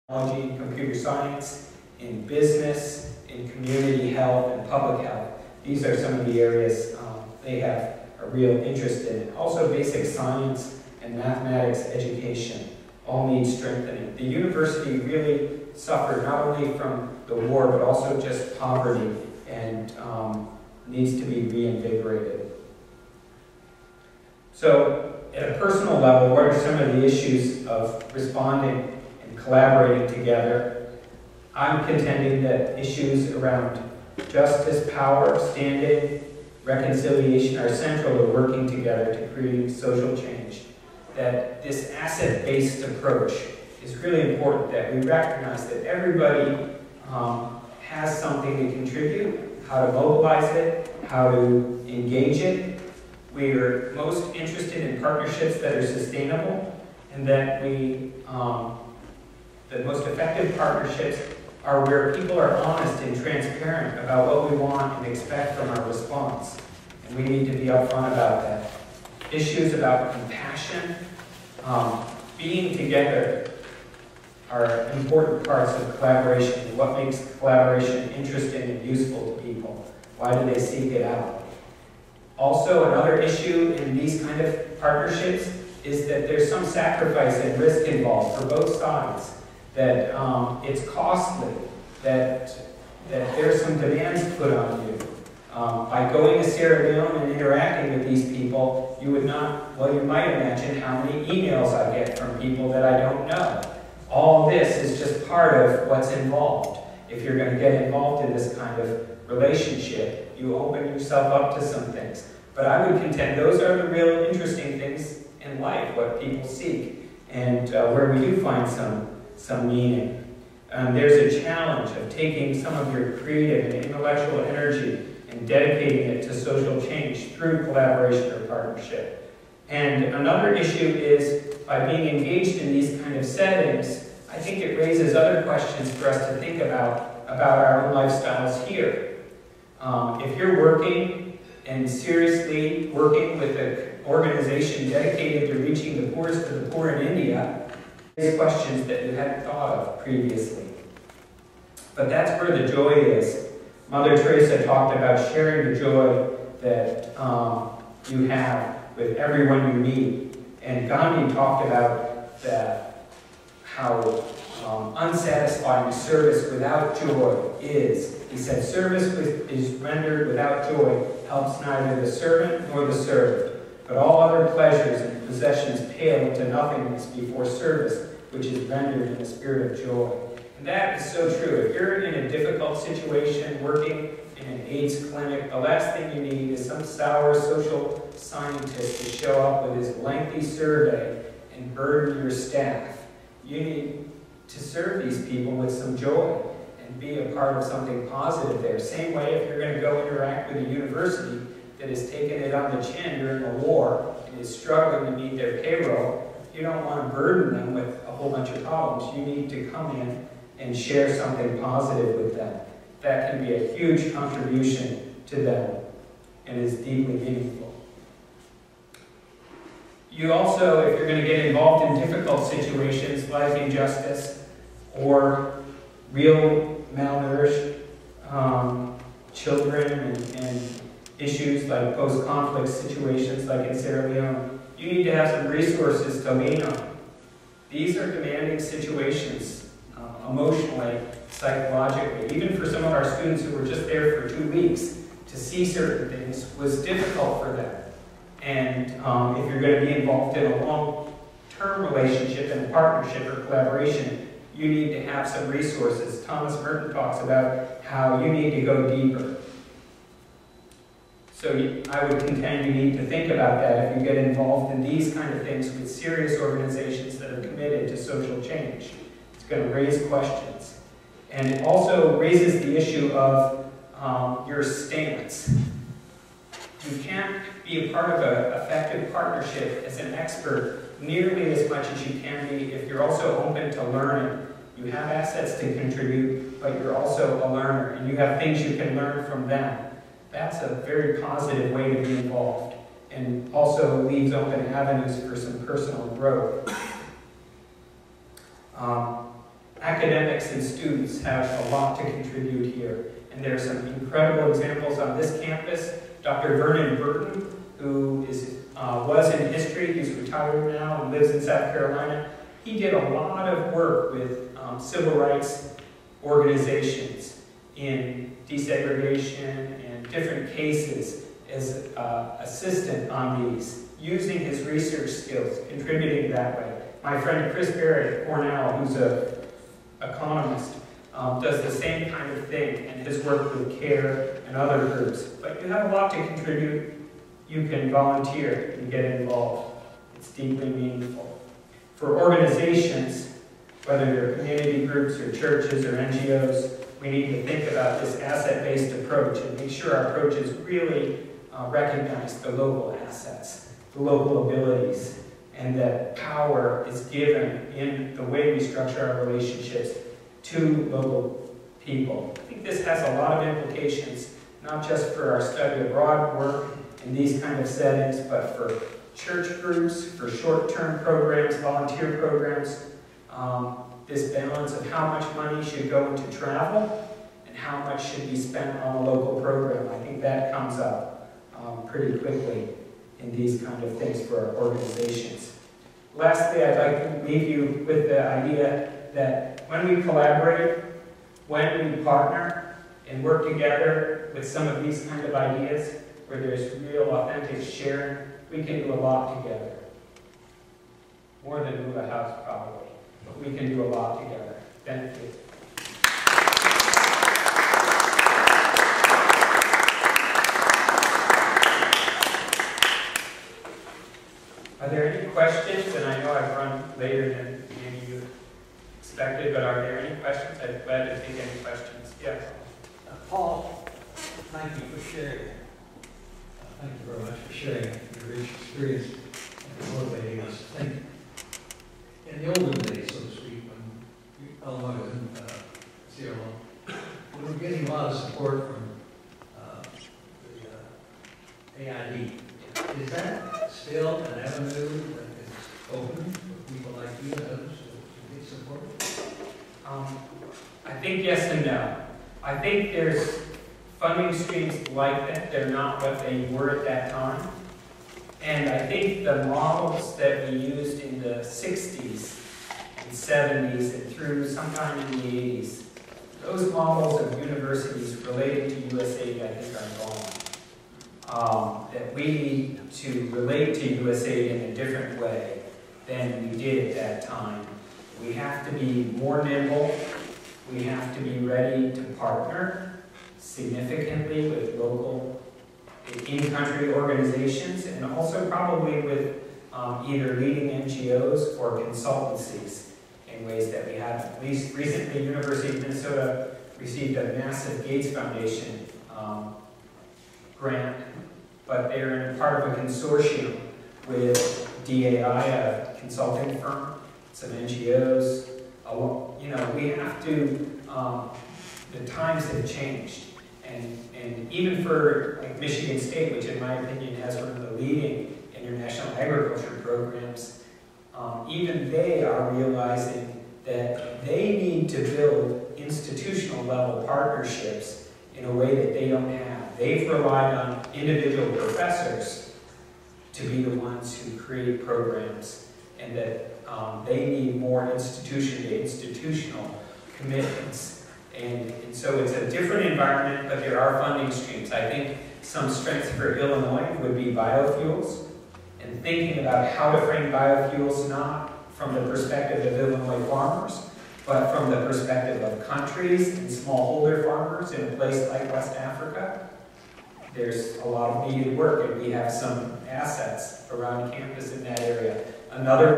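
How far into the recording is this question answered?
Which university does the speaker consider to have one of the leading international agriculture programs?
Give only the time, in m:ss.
8:35.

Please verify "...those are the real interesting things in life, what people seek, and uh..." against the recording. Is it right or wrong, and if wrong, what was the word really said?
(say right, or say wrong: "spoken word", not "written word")
right.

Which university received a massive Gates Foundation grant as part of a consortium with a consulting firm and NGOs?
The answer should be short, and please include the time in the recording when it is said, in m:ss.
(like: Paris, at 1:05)
University of Minnesota, at 8:15.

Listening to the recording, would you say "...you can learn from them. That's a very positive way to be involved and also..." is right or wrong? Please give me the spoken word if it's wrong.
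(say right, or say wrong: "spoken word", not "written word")
right.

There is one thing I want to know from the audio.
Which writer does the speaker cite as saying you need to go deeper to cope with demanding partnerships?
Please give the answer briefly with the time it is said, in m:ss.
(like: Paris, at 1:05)
Thomas Merton, at 4:16.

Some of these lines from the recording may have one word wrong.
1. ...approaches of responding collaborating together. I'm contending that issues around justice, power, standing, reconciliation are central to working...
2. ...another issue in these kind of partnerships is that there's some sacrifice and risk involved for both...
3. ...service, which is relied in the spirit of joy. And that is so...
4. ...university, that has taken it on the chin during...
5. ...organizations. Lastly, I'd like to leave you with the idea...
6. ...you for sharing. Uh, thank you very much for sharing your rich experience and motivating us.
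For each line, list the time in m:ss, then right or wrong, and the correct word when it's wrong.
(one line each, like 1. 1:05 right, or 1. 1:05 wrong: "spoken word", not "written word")
1. 0:27 wrong: "issues", not "approaches"
2. 1:22 right
3. 2:57 wrong: "rendered", not "relied"
4. 3:20 right
5. 6:24 right
6. 7:04 right.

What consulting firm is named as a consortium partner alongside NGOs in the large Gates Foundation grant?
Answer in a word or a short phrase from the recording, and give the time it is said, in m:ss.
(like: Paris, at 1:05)
DAI, at 8:24.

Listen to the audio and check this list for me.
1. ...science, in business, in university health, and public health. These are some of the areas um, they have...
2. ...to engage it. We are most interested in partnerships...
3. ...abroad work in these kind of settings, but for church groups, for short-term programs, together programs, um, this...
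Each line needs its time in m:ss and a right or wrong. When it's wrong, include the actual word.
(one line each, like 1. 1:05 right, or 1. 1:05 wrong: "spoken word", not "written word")
1. 0:00 wrong: "community", not "university"
2. 0:51 right
3. 6:05 wrong: "volunteer", not "together".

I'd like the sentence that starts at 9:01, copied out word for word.
And, and so it's a different environment, but there are funding streams.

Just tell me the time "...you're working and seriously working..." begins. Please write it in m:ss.
2:20.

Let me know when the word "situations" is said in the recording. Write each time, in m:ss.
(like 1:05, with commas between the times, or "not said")
3:02, 3:42, 3:52, 3:58.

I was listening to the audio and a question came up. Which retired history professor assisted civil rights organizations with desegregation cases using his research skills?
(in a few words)
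Vernon Burton.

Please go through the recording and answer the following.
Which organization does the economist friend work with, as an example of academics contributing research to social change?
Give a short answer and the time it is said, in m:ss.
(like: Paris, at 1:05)
CARE, at 5:33.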